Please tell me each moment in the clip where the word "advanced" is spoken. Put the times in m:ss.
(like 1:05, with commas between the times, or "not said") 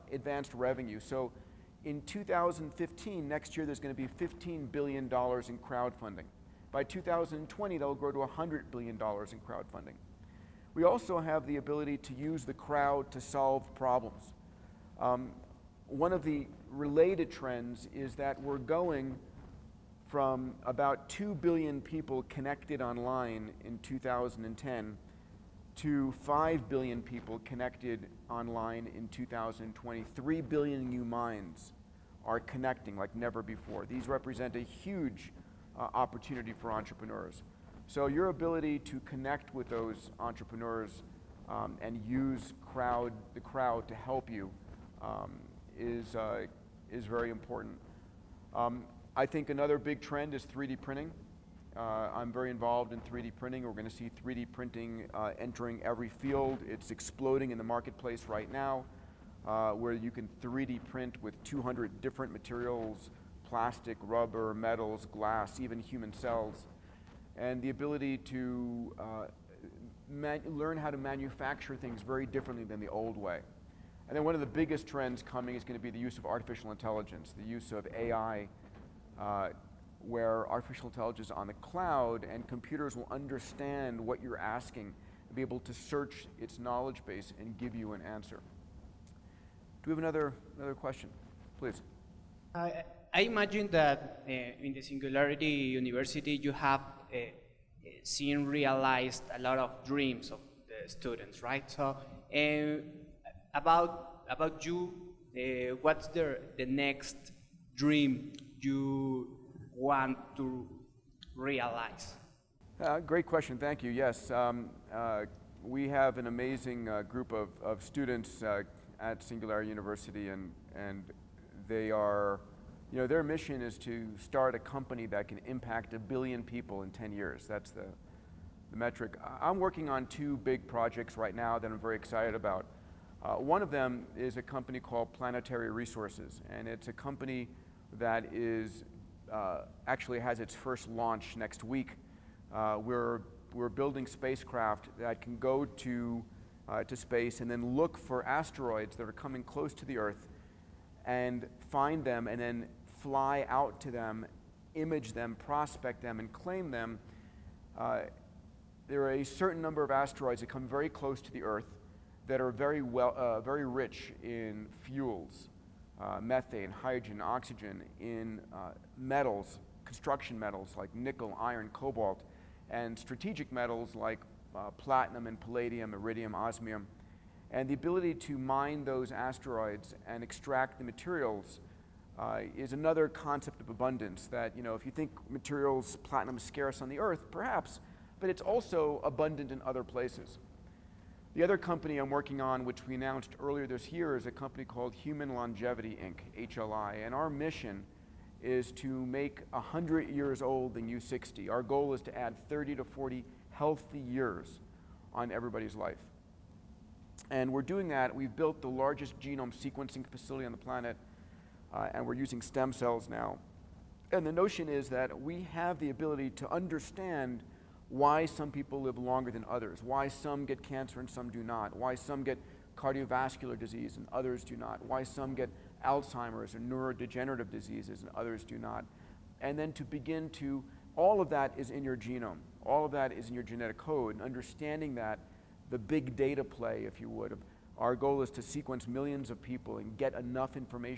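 0:00.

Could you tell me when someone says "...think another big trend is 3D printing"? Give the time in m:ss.
0:49.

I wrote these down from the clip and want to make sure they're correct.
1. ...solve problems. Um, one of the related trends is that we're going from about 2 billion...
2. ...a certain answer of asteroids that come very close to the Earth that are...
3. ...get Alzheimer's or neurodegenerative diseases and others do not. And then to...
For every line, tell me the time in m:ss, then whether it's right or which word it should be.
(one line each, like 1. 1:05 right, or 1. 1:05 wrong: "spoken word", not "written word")
1. 0:13 right
2. 2:39 wrong: "number", not "answer"
3. 3:45 right.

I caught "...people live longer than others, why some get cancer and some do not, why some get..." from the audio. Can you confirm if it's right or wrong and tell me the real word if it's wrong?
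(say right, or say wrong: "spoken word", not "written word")
right.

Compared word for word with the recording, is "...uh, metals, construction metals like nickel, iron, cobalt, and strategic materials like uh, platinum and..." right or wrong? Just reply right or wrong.
wrong.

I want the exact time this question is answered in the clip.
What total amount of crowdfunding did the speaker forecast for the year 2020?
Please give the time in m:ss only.
0:08.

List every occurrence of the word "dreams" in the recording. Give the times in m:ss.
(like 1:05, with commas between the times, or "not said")
1:39, 1:47.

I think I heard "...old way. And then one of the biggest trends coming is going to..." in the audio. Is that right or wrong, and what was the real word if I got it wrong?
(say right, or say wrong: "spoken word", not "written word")
right.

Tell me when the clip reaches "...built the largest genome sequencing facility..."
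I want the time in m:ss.
3:28.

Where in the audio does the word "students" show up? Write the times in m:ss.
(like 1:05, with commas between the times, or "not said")
1:40, 1:57.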